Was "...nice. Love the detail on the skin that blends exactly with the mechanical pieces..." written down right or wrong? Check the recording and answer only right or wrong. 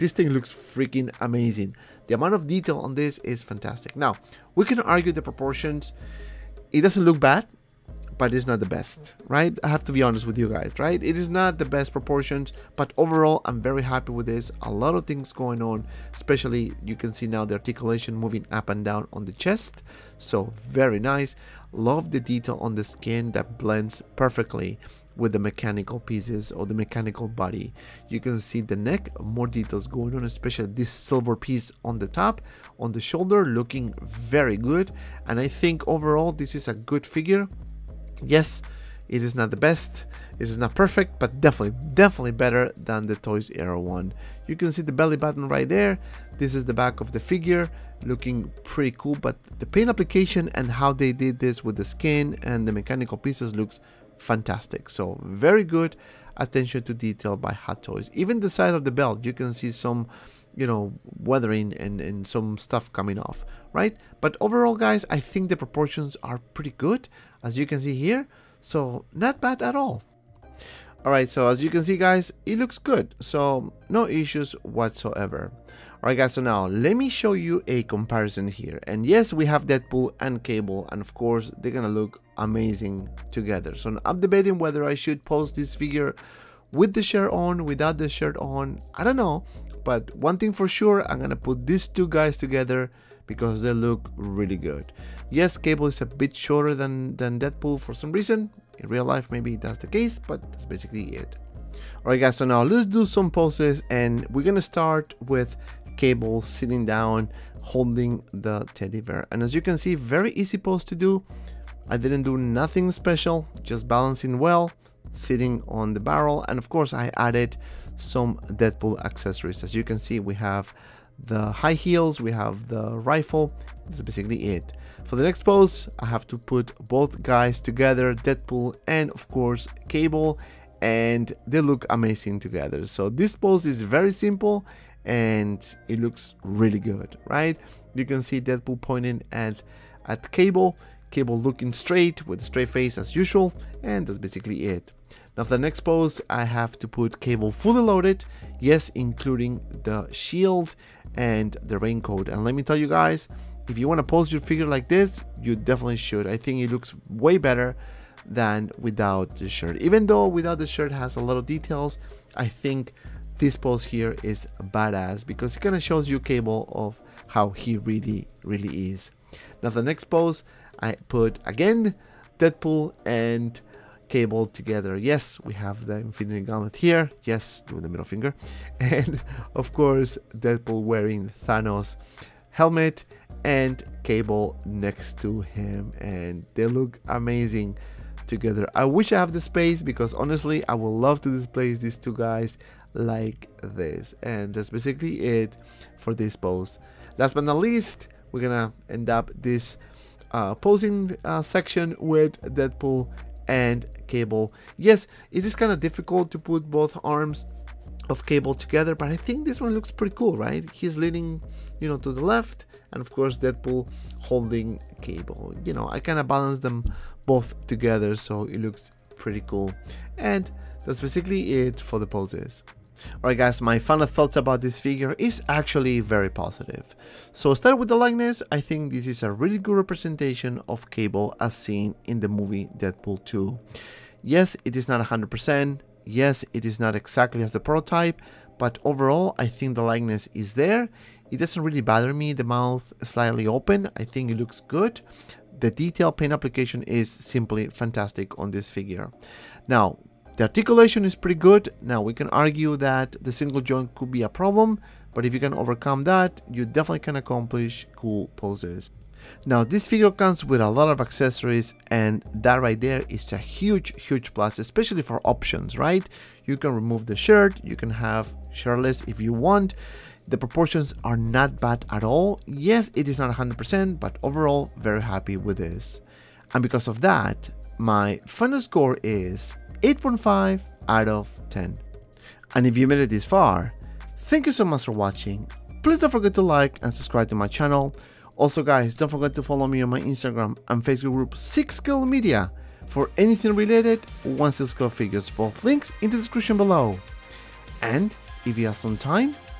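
wrong.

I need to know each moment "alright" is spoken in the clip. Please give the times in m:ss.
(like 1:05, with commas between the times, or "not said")
1:11, 1:16, 1:42, 3:43.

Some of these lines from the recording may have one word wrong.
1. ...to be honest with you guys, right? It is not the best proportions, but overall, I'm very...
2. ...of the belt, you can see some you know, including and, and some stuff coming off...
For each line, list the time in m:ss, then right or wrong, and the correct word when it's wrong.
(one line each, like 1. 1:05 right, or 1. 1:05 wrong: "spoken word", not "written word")
1. 0:09 right
2. 0:58 wrong: "weathering", not "including".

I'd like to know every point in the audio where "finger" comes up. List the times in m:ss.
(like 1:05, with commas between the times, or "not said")
2:58.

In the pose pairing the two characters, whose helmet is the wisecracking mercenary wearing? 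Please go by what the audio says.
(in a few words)
Thanos.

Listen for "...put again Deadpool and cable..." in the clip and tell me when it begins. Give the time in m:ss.
2:51.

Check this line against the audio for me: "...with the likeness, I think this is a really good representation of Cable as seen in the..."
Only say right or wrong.
right.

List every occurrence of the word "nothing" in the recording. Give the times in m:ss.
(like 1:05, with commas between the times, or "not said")
1:52.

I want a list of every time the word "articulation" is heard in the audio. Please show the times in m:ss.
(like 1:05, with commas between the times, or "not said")
0:17, 4:10.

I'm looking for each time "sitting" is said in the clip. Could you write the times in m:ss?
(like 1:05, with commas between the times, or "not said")
1:46, 1:55.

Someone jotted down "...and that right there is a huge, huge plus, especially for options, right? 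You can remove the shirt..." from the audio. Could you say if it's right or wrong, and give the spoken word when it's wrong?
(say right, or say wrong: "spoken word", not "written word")
right.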